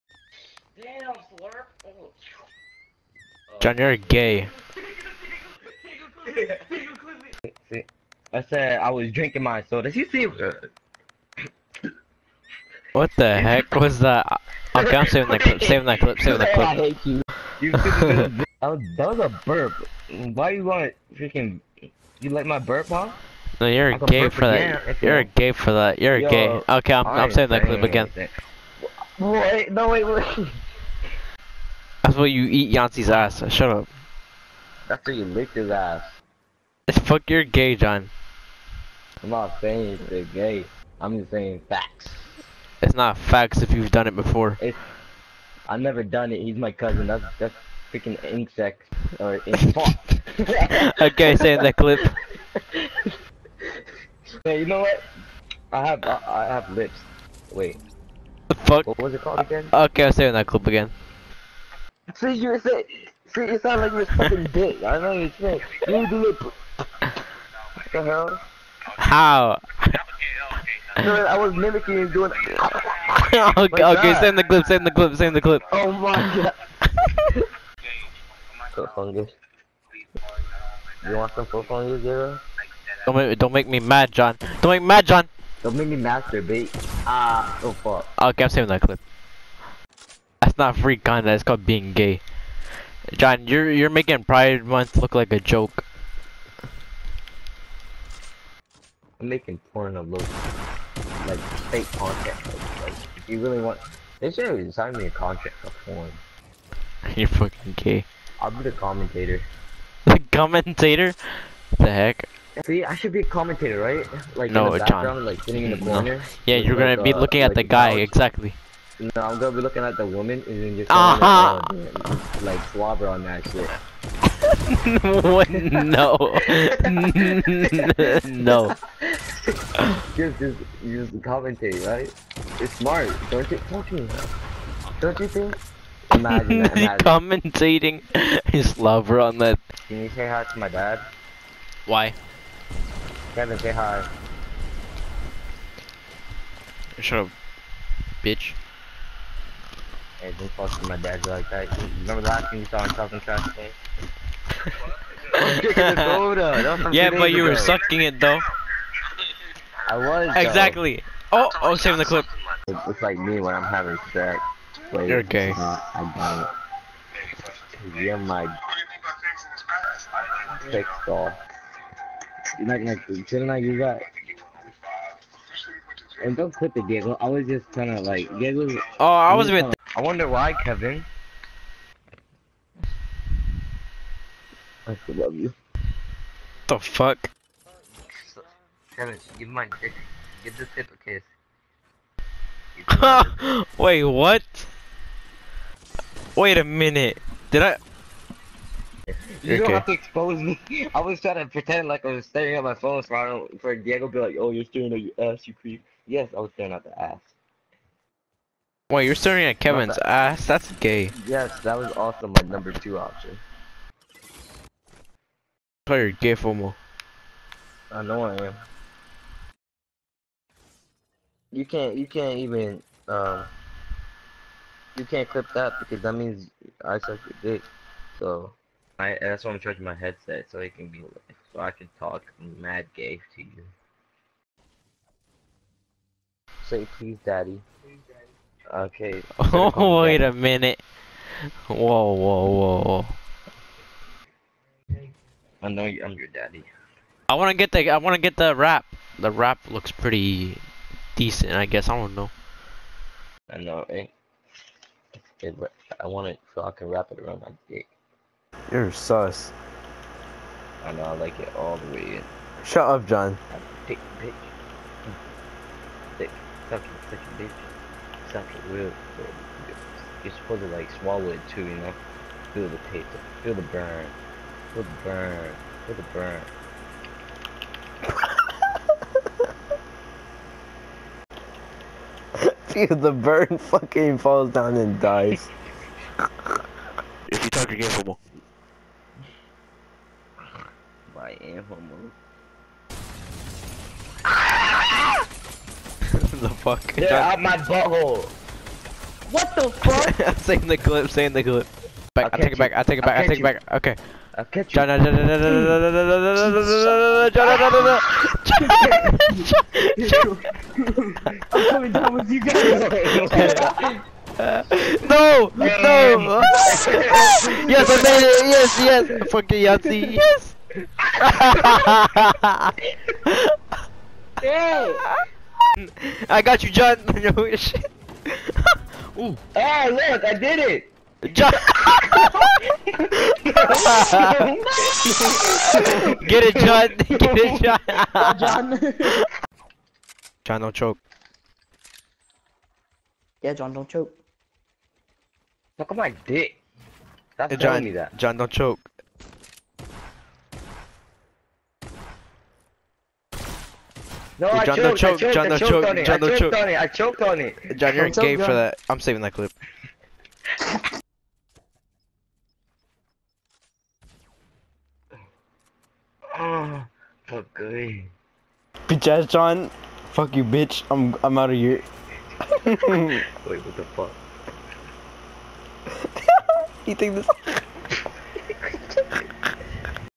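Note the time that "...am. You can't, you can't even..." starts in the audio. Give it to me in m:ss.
3:38.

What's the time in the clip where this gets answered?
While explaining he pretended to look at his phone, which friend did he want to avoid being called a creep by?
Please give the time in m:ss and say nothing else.
3:23.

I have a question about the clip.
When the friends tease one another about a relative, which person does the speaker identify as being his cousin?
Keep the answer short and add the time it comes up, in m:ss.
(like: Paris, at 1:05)
Yancy, at 0:32.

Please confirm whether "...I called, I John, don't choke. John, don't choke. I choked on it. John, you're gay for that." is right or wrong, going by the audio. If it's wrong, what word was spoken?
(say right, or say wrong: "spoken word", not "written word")
wrong: "choked", not "called".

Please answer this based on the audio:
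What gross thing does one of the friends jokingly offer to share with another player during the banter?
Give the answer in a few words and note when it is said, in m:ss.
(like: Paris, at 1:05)
Foot fungus, at 1:21.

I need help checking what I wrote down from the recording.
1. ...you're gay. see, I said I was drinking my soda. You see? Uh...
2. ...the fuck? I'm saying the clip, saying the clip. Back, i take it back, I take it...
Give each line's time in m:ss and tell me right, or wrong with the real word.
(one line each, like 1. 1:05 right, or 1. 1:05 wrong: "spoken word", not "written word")
1. 0:03 right
2. 4:59 right.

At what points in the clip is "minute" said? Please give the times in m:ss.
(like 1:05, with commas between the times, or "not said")
3:16, 4:00.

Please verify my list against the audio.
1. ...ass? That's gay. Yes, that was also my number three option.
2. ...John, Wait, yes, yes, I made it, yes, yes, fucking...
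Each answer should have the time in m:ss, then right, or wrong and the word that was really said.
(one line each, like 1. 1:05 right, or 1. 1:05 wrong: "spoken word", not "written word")
1. 3:30 wrong: "two", not "three"
2. 5:15 wrong: "John", not "Wait".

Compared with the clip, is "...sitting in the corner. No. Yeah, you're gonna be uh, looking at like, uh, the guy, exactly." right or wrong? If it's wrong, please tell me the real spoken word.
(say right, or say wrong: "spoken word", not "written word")
right.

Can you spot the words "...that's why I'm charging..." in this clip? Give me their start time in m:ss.
3:49.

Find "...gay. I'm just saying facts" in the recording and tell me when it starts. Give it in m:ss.
0:40.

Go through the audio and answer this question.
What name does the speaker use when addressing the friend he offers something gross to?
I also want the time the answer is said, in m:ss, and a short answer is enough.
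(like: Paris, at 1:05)
Zero, at 1:22.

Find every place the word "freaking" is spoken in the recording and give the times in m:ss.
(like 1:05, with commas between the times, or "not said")
0:21, 0:47.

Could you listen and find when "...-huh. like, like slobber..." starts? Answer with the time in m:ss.
2:01.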